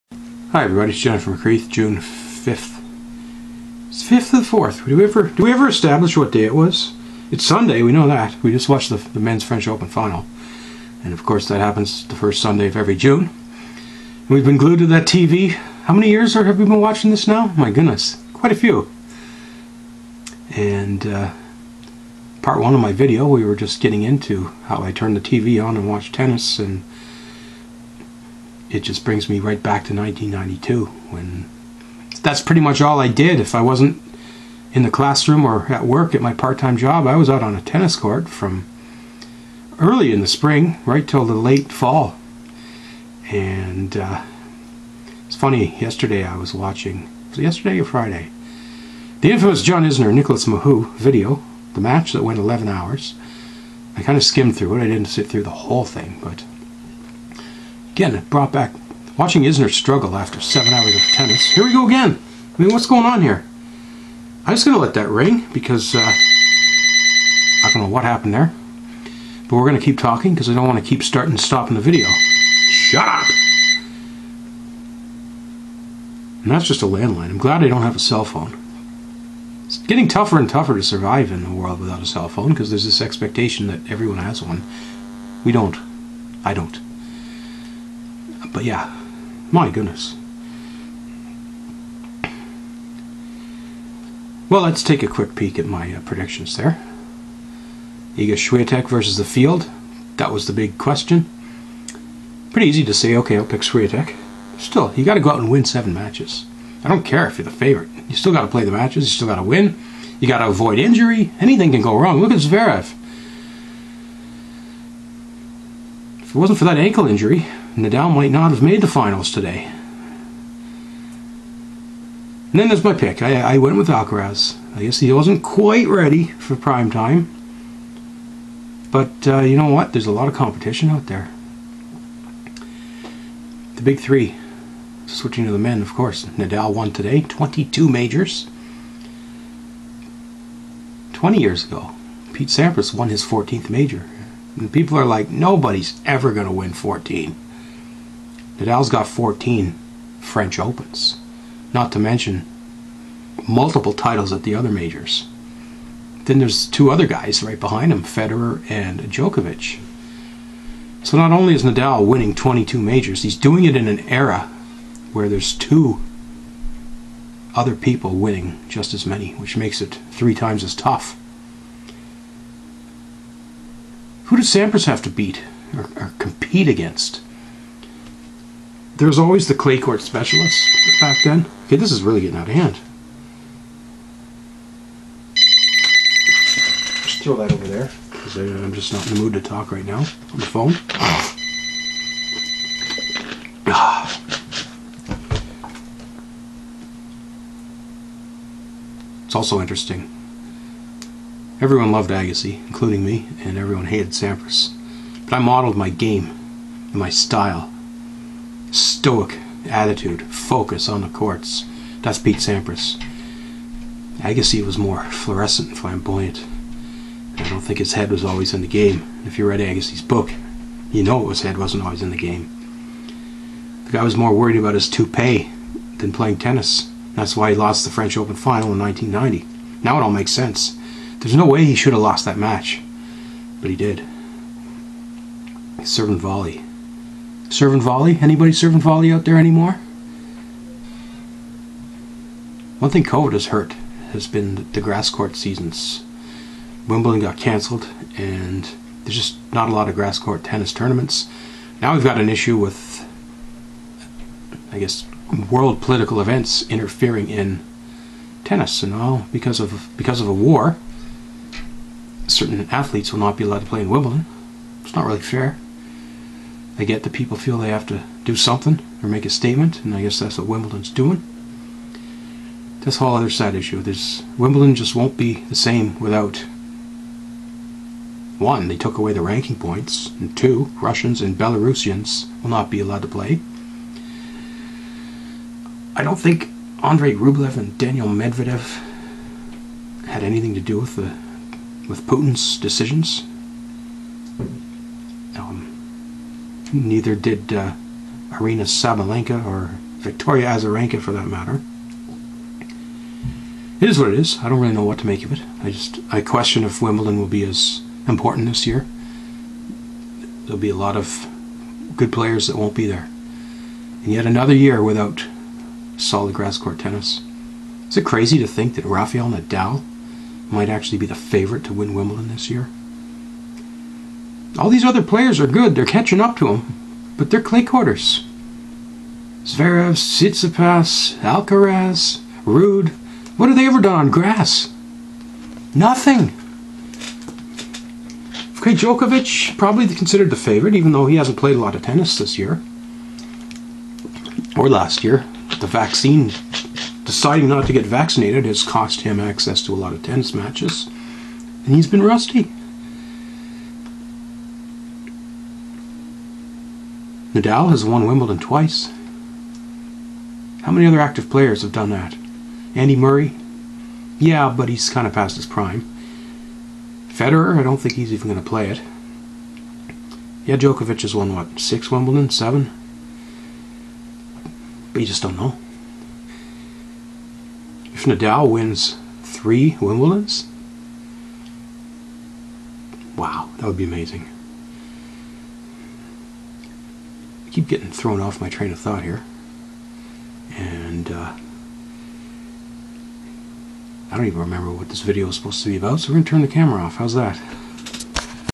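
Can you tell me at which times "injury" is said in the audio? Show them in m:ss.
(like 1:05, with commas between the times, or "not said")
1:50, 1:57.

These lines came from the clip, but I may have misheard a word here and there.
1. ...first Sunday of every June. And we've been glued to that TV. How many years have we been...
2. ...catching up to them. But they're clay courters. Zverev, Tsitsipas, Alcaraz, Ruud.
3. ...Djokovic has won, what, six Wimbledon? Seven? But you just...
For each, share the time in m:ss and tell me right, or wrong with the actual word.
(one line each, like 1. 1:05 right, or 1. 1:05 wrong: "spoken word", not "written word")
1. 0:12 right
2. 5:25 right
3. 6:10 right.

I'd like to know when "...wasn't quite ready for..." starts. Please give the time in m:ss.
2:05.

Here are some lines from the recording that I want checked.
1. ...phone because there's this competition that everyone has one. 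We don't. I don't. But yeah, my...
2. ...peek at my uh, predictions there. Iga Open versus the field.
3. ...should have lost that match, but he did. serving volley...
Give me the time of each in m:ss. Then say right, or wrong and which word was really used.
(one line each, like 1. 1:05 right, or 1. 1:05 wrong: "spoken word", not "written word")
1. 1:22 wrong: "expectation", not "competition"
2. 1:35 wrong: "Swiatek", not "Open"
3. 3:51 right.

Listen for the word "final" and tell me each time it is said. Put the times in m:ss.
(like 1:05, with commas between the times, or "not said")
0:09, 1:58, 3:48.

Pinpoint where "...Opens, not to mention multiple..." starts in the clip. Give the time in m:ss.
2:30.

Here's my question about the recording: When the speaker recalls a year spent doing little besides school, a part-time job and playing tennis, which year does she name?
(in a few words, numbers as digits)
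1992.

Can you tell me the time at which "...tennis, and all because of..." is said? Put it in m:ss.
4:18.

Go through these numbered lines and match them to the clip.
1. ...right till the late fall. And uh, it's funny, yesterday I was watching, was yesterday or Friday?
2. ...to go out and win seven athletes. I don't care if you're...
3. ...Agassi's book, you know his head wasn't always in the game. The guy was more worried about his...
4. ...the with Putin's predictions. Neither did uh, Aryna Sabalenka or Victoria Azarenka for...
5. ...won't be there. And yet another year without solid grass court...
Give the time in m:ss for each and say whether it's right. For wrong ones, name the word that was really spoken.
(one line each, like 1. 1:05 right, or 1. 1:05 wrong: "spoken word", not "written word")
1. 0:40 right
2. 1:45 wrong: "matches", not "athletes"
3. 3:39 right
4. 4:50 wrong: "decisions", not "predictions"
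5. 5:12 right.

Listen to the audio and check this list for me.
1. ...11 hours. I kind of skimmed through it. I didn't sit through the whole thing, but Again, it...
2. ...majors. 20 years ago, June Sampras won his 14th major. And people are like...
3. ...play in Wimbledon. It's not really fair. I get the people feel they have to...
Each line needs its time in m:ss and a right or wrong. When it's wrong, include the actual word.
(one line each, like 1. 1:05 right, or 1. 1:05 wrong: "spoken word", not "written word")
1. 0:52 right
2. 2:17 wrong: "Pete", not "June"
3. 4:23 right.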